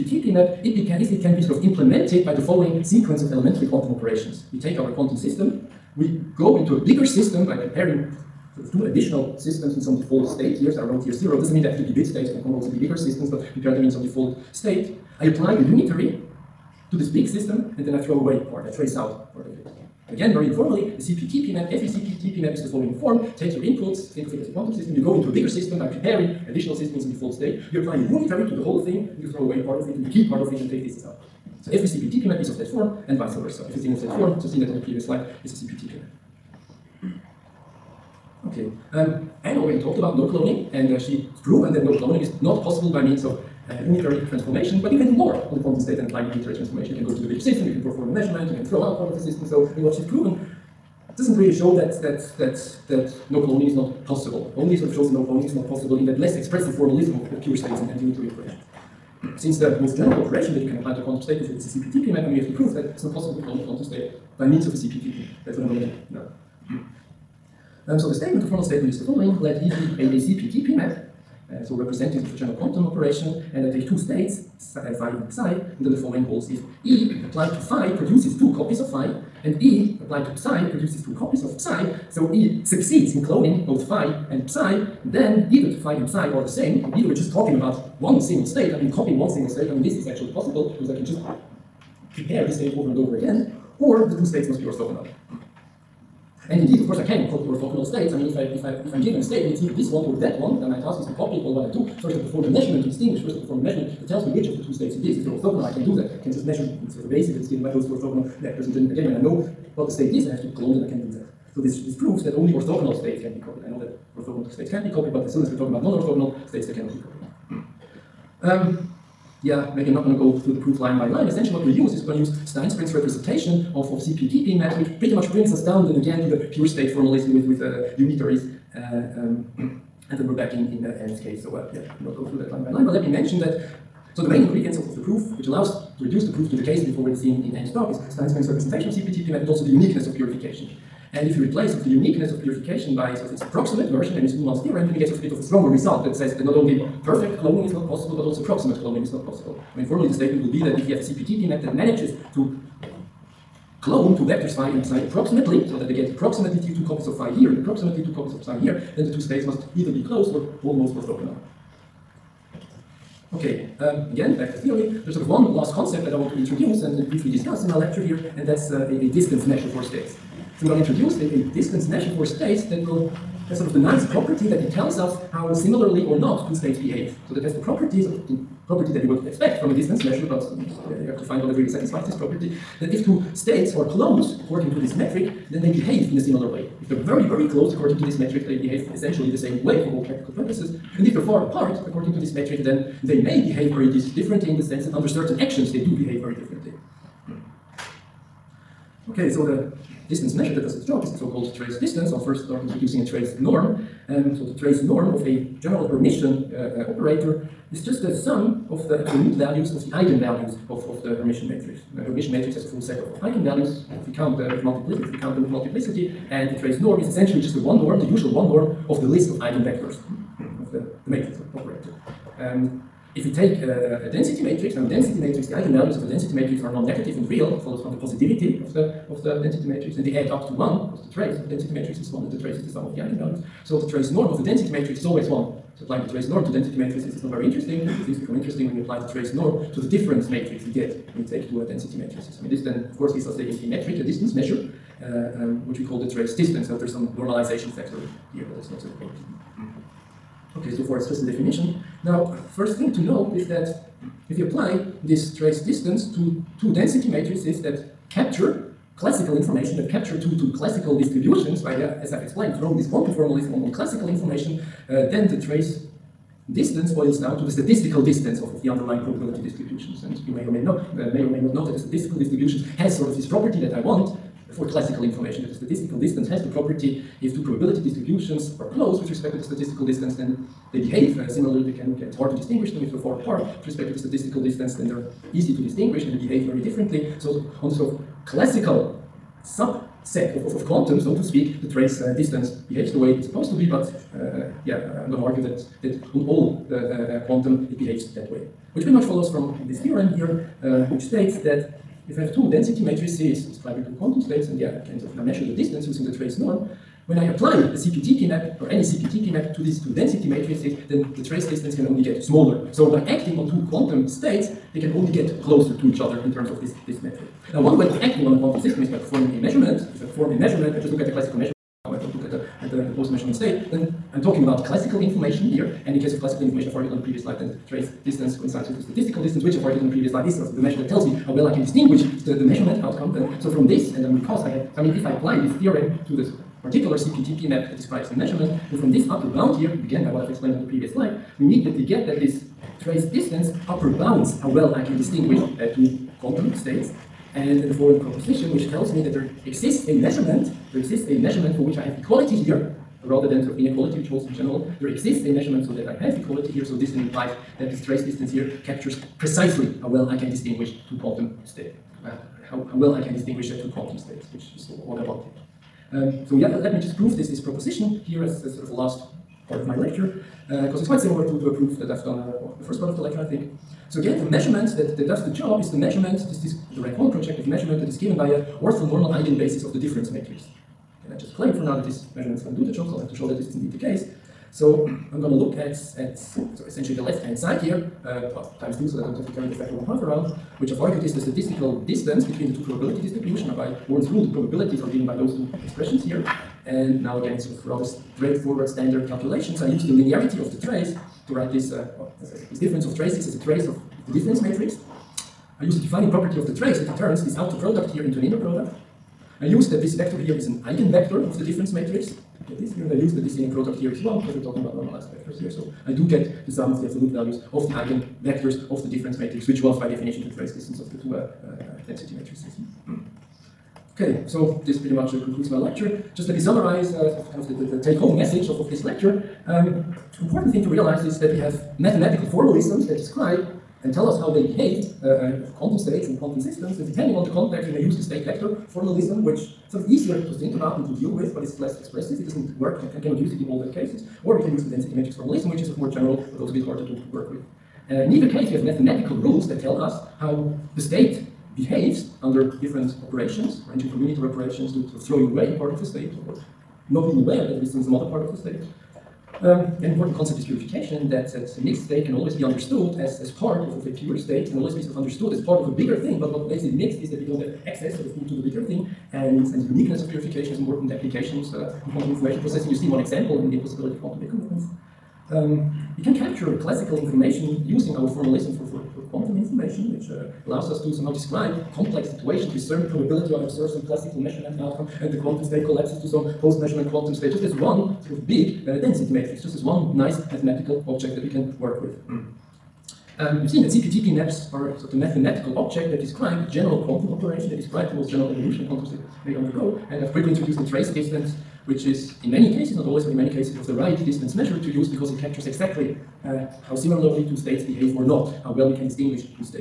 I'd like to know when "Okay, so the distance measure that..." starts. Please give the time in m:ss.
3:19.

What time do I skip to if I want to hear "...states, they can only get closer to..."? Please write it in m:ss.
5:14.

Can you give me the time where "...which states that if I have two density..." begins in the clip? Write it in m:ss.
5:00.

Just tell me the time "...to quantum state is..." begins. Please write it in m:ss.
1:00.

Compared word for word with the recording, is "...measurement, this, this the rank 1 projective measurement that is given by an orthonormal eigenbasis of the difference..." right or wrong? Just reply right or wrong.
right.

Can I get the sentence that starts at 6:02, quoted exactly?
Uh, how, how, well I can distinguish uh, two quantum states, which is what I wanted.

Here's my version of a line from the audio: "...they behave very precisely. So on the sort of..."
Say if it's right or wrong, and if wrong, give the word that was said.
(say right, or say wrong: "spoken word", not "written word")
wrong: "differently", not "precisely".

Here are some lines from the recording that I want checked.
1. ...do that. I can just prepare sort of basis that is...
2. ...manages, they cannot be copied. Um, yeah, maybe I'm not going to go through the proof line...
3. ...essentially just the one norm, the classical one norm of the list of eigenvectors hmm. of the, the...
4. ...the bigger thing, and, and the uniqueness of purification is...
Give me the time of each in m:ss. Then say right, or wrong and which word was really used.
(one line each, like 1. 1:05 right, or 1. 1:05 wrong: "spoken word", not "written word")
1. 1:45 wrong: "measure", not "prepare"
2. 1:56 wrong: "states", not "manages"
3. 3:37 wrong: "usual", not "classical"
4. 7:48 right.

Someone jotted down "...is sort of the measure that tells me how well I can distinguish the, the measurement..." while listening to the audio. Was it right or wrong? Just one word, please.
right.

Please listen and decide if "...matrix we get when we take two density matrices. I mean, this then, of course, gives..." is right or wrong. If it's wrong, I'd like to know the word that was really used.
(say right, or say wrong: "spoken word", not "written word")
right.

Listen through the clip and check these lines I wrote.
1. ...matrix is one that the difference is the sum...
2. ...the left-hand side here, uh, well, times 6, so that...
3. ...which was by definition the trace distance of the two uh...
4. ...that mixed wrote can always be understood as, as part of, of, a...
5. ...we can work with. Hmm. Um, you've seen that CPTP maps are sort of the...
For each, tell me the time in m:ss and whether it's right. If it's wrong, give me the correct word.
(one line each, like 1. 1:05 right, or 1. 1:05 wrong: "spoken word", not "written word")
1. 3:51 wrong: "trace", not "difference"
2. 6:26 wrong: "2", not "6"
3. 6:59 right
4. 7:41 wrong: "state", not "wrote"
5. 8:11 right.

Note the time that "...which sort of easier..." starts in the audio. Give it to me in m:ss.
7:19.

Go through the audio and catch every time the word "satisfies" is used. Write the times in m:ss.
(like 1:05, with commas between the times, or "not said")
3:01.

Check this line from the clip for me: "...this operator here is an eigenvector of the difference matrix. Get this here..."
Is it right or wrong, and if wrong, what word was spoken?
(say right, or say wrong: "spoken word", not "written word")
wrong: "vector", not "operator".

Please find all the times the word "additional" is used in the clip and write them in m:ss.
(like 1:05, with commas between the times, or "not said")
0:08, 0:26.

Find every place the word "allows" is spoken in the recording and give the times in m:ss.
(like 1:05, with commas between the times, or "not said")
2:15, 8:00.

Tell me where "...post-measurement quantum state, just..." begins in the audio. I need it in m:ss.
8:06.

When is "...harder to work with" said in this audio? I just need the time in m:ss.
7:26.